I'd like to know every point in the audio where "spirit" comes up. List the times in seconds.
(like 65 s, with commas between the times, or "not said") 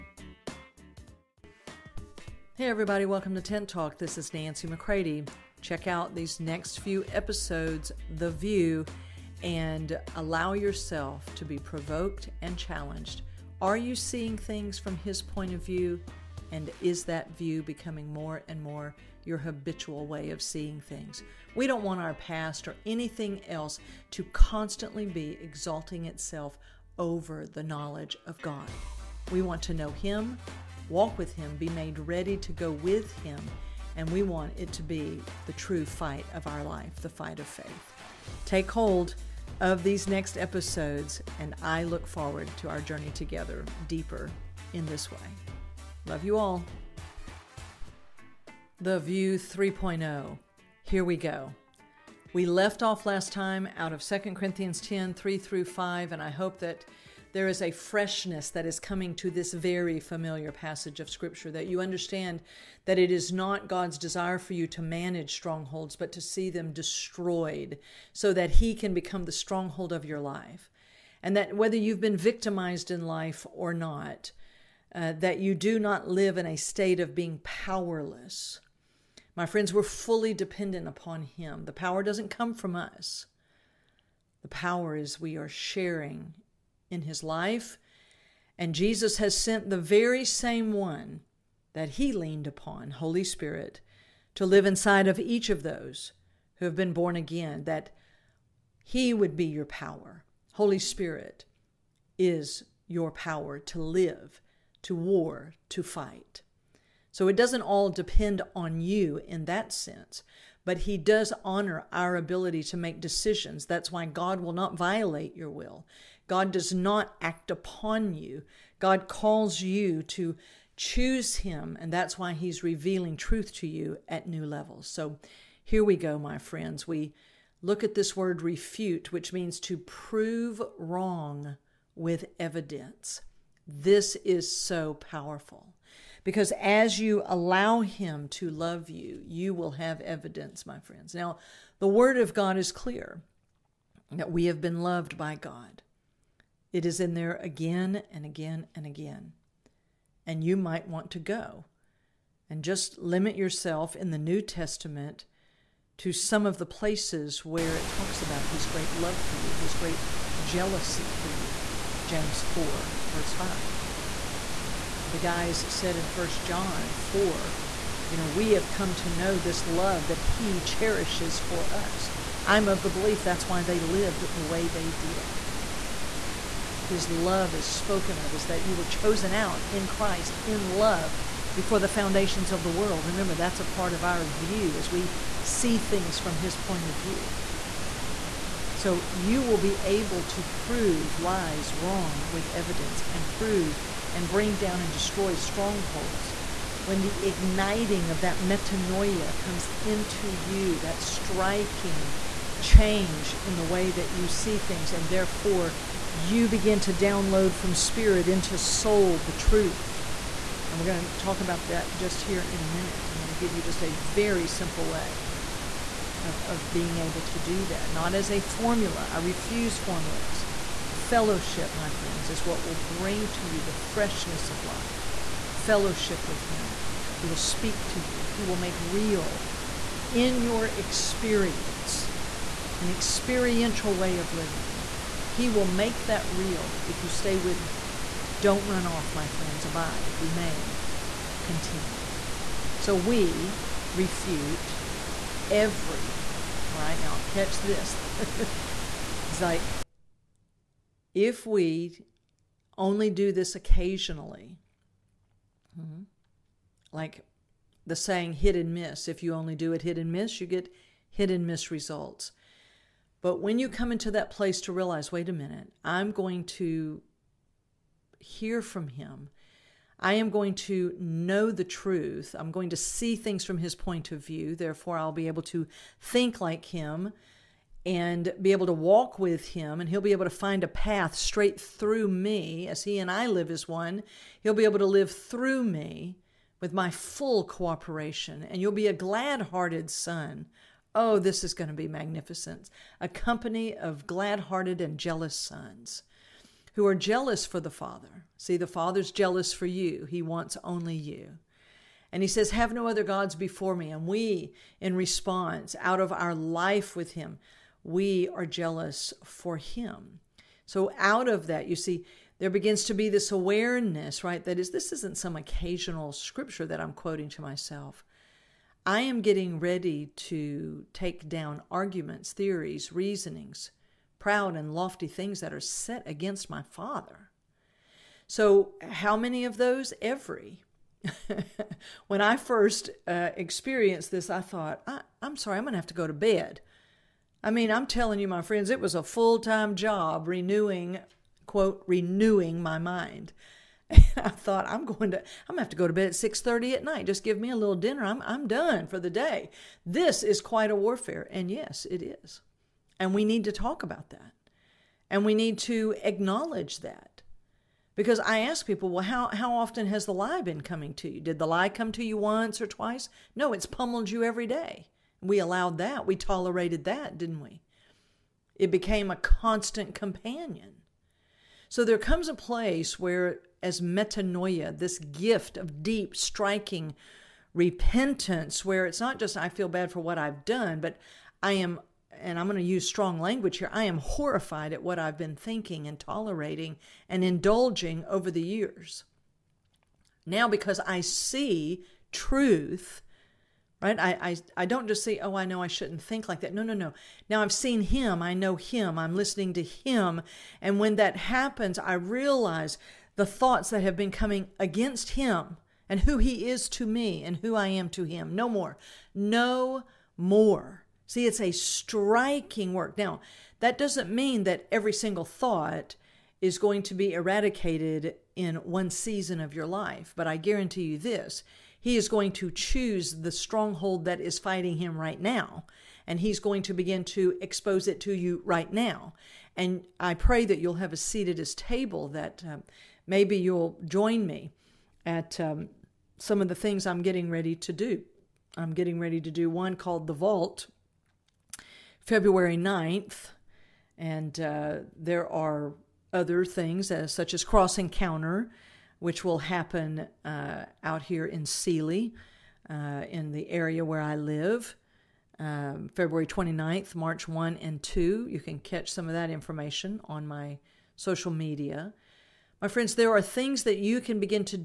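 93 s, 100 s, 207 s.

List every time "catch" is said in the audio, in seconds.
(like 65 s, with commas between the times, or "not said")
247 s, 458 s.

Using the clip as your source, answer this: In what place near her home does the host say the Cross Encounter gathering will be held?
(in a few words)
Sealy.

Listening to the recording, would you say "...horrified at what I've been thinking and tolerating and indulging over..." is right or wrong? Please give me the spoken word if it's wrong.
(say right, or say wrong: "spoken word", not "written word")
right.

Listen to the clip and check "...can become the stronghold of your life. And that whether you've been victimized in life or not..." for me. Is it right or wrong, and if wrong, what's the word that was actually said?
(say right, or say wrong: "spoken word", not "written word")
right.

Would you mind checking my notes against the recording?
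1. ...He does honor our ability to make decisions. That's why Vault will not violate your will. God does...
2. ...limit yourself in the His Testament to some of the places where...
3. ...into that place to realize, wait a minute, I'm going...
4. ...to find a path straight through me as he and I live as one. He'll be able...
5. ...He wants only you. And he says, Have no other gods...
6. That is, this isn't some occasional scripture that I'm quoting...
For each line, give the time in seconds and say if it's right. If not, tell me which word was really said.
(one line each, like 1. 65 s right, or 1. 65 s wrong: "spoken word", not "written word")
1. 110 s wrong: "God", not "Vault"
2. 152 s wrong: "New", not "His"
3. 263 s right
4. 280 s right
5. 300 s right
6. 314 s right.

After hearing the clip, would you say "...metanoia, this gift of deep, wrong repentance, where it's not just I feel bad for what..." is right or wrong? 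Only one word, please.
wrong.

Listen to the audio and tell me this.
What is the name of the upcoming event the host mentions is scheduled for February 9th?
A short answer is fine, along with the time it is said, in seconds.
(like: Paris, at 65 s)
The Vault, at 440 s.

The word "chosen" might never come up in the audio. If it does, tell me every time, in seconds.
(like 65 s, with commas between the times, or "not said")
178 s.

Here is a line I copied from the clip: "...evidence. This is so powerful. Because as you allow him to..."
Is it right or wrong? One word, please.
right.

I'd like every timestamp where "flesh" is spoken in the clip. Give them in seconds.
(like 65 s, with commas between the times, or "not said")
not said.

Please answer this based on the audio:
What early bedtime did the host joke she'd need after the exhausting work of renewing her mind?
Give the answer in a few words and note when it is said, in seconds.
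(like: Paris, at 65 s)
6:30, at 346 s.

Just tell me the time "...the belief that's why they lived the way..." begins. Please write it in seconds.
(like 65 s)
172 s.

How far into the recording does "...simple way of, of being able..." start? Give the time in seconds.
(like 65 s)
214 s.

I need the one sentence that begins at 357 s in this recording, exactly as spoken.
Because I ask people, well, how, how often has the lie been coming to you?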